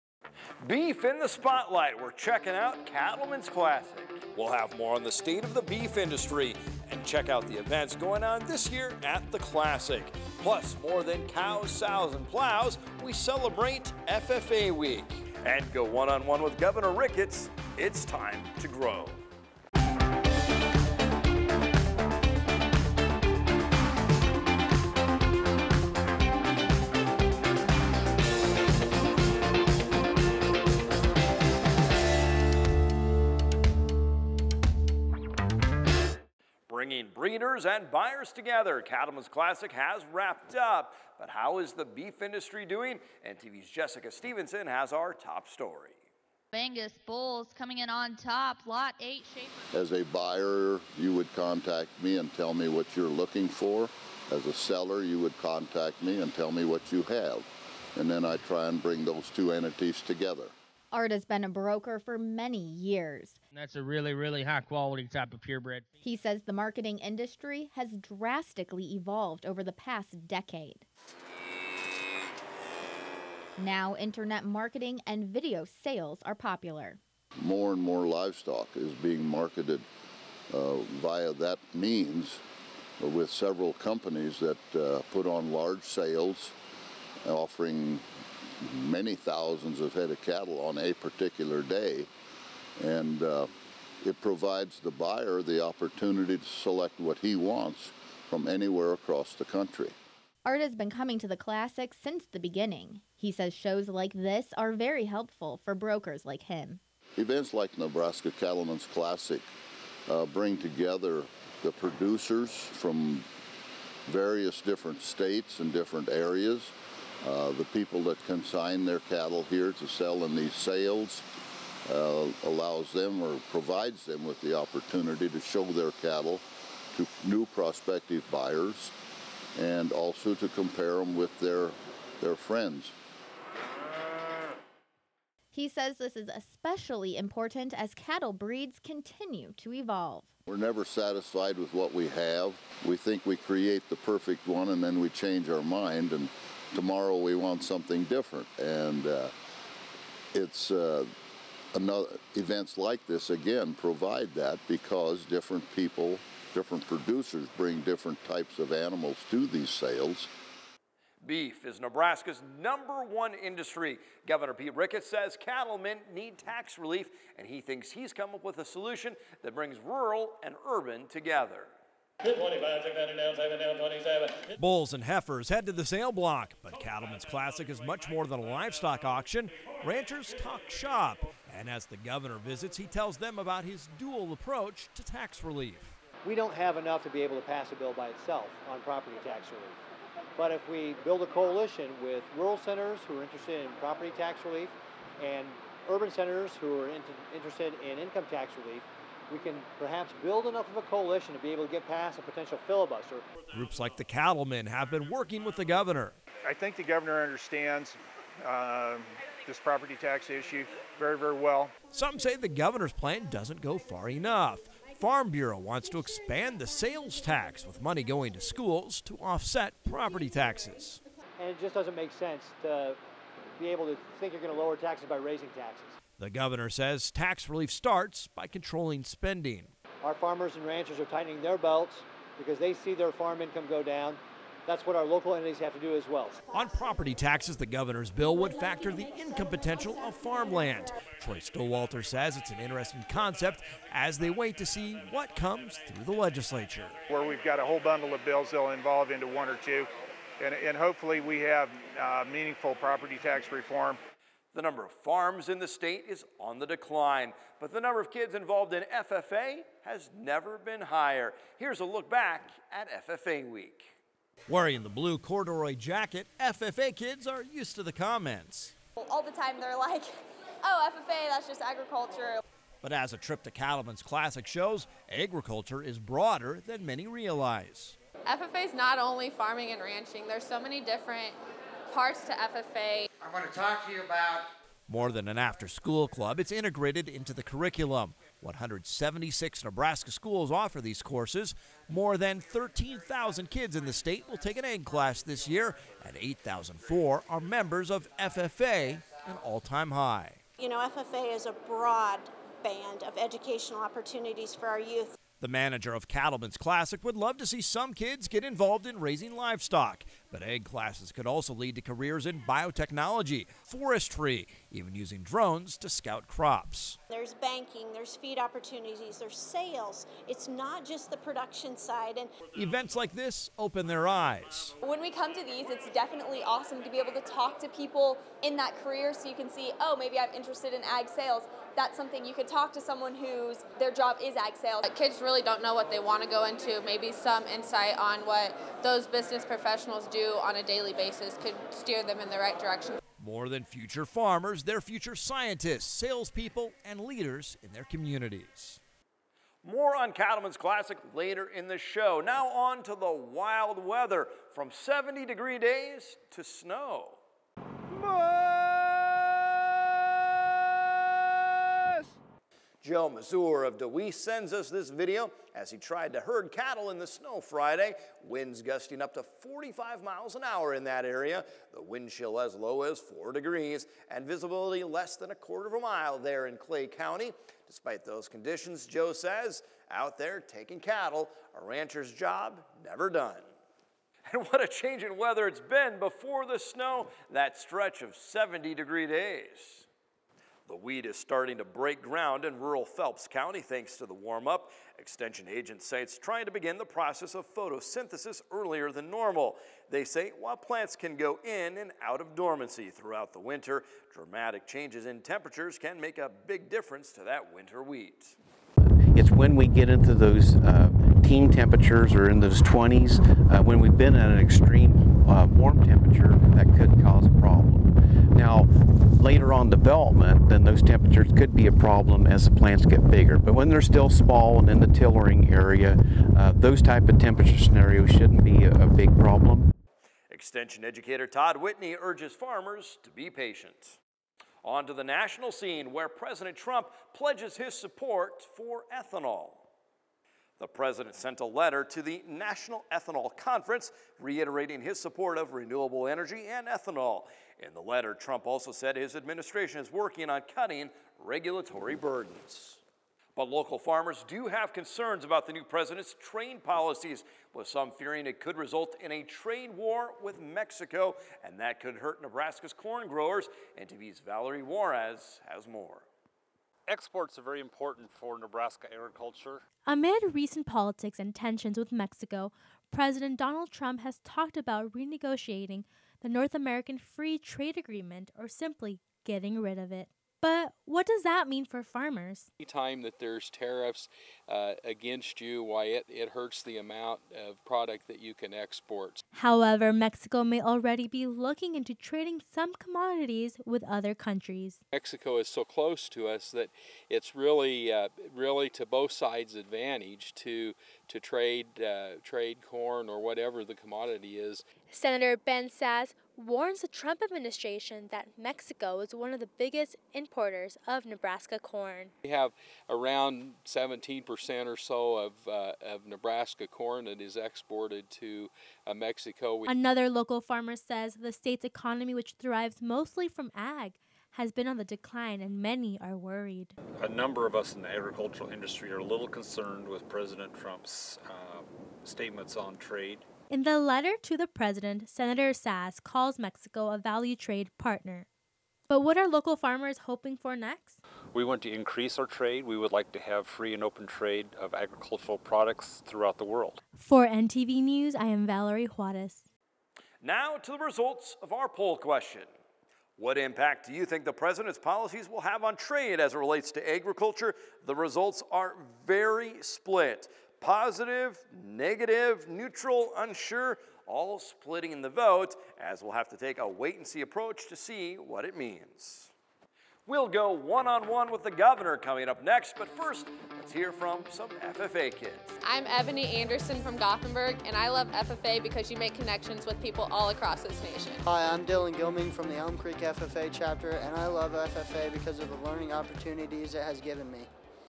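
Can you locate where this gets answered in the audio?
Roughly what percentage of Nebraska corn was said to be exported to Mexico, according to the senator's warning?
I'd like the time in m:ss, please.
8:33.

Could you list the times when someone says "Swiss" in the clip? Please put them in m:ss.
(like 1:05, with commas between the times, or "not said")
not said.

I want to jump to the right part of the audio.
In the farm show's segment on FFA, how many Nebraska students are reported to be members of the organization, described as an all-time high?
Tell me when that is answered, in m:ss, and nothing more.
4:56.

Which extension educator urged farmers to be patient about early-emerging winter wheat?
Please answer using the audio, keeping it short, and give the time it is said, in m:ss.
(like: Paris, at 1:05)
Todd Whitney, at 7:11.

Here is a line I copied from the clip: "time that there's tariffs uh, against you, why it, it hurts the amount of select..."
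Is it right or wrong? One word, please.
wrong.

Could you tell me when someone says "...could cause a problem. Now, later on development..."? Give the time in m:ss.
6:56.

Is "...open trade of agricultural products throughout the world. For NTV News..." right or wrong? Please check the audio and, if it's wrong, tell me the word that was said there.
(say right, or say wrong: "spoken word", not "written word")
right.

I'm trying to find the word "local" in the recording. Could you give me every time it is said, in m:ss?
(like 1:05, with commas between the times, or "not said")
3:55, 7:33, 8:40, 8:59.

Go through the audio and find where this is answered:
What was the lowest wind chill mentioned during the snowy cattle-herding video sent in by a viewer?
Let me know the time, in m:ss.
6:12.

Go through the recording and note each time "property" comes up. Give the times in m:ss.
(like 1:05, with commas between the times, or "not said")
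3:08, 3:13, 3:29, 3:39, 3:56, 4:12.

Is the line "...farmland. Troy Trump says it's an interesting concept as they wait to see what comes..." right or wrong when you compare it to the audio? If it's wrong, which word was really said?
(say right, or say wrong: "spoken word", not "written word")
wrong: "Stowater", not "Trump".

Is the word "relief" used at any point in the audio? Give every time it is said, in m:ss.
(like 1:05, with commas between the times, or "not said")
2:46, 3:05, 3:09, 3:14, 3:18, 3:47.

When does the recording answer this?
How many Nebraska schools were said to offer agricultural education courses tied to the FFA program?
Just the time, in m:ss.
4:48.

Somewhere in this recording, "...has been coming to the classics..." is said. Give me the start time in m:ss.
1:40.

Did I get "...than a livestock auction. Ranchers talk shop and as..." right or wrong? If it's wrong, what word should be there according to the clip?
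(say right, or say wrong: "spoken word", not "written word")
right.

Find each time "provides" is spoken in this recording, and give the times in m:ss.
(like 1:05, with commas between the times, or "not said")
1:34, 2:03, 2:33.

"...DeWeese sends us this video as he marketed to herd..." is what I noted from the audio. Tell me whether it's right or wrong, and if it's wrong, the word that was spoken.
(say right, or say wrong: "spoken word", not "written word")
wrong: "tried", not "marketed".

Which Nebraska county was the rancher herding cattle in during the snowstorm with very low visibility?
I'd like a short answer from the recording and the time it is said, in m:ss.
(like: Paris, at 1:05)
Clay County, at 6:16.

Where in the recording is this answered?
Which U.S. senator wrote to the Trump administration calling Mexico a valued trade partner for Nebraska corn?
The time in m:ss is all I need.
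8:25.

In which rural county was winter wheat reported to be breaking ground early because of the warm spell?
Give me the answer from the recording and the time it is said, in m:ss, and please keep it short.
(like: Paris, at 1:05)
Phelps County, at 6:32.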